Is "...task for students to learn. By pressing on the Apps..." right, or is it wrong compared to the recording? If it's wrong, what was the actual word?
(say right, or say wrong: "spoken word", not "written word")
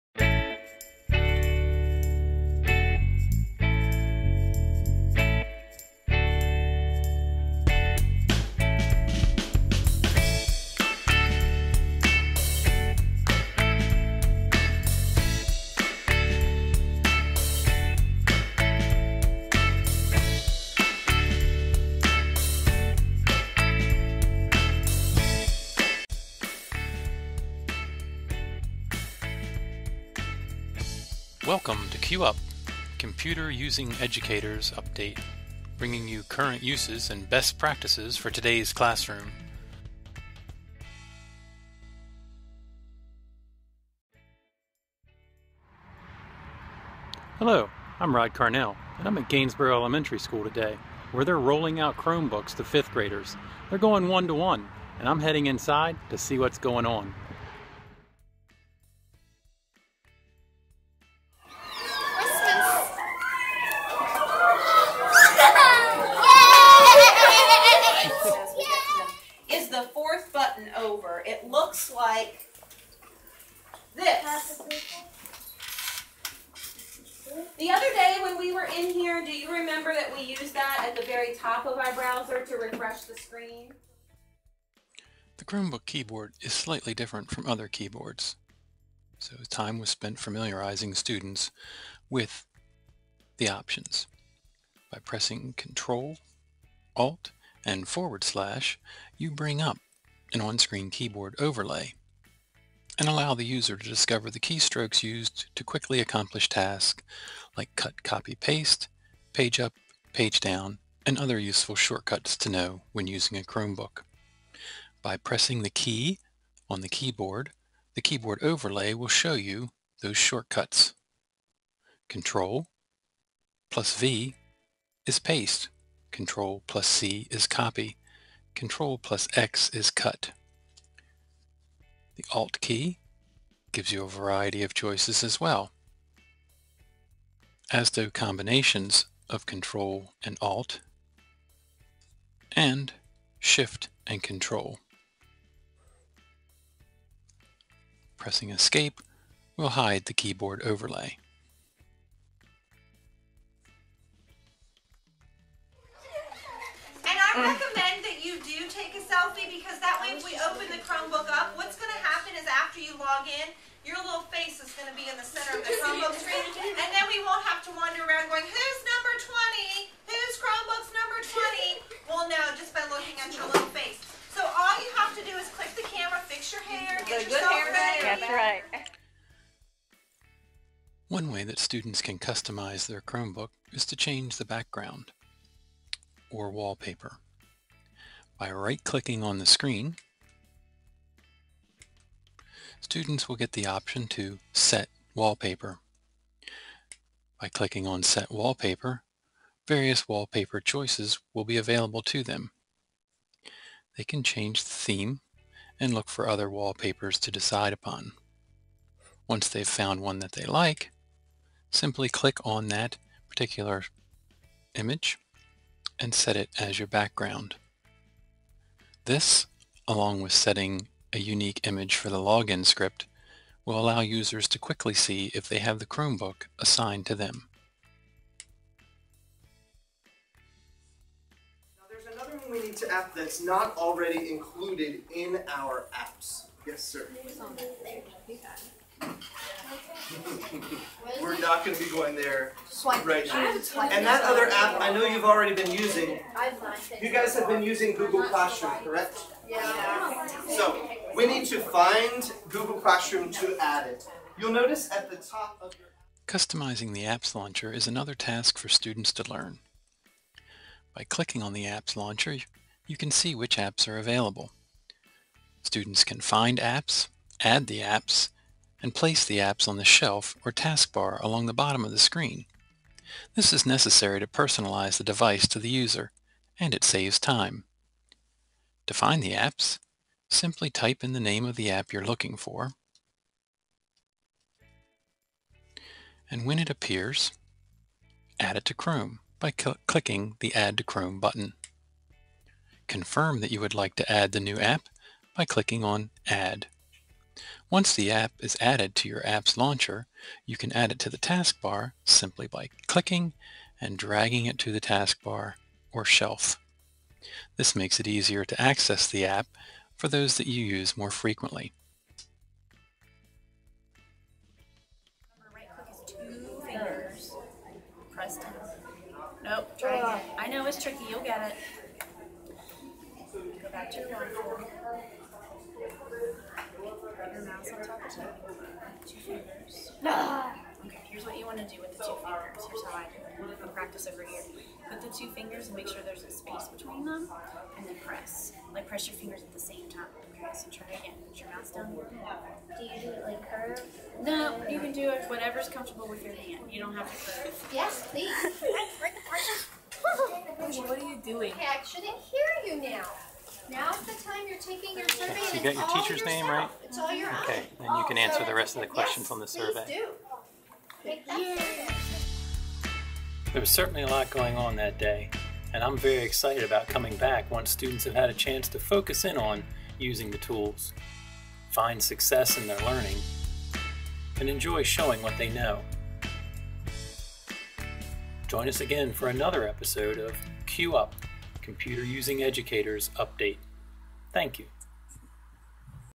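wrong: "clicking", not "pressing".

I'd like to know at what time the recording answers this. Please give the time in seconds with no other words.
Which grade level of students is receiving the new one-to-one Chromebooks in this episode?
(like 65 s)
52 s.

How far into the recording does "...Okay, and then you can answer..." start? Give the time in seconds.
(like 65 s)
357 s.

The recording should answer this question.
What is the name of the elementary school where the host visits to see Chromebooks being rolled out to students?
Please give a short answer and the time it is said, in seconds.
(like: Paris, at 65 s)
Gainsborough Elementary School, at 49 s.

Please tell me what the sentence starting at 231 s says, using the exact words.
Now there's another one we need to add that's not already included in our apps.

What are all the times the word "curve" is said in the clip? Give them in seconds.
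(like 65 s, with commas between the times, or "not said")
343 s, 347 s.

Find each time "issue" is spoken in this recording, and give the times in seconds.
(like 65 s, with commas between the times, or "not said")
not said.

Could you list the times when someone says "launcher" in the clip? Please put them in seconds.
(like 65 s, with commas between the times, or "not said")
257 s, 261 s, 299 s.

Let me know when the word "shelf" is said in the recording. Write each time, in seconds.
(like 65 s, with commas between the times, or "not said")
269 s, 306 s.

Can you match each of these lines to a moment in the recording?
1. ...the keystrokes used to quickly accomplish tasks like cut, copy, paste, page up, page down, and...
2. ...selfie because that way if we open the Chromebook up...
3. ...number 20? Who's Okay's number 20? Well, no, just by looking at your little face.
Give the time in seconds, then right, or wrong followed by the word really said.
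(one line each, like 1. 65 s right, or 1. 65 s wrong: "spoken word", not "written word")
1. 104 s right
2. 159 s right
3. 168 s wrong: "Chromebook", not "Okay".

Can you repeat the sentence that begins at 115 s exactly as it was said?
By pressing the key on the keyboard, the keyboard overlay will show you those shortcuts.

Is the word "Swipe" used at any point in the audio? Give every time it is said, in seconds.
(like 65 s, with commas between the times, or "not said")
242 s.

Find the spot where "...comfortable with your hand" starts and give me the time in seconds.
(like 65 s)
345 s.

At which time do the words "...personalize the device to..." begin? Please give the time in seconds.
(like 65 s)
274 s.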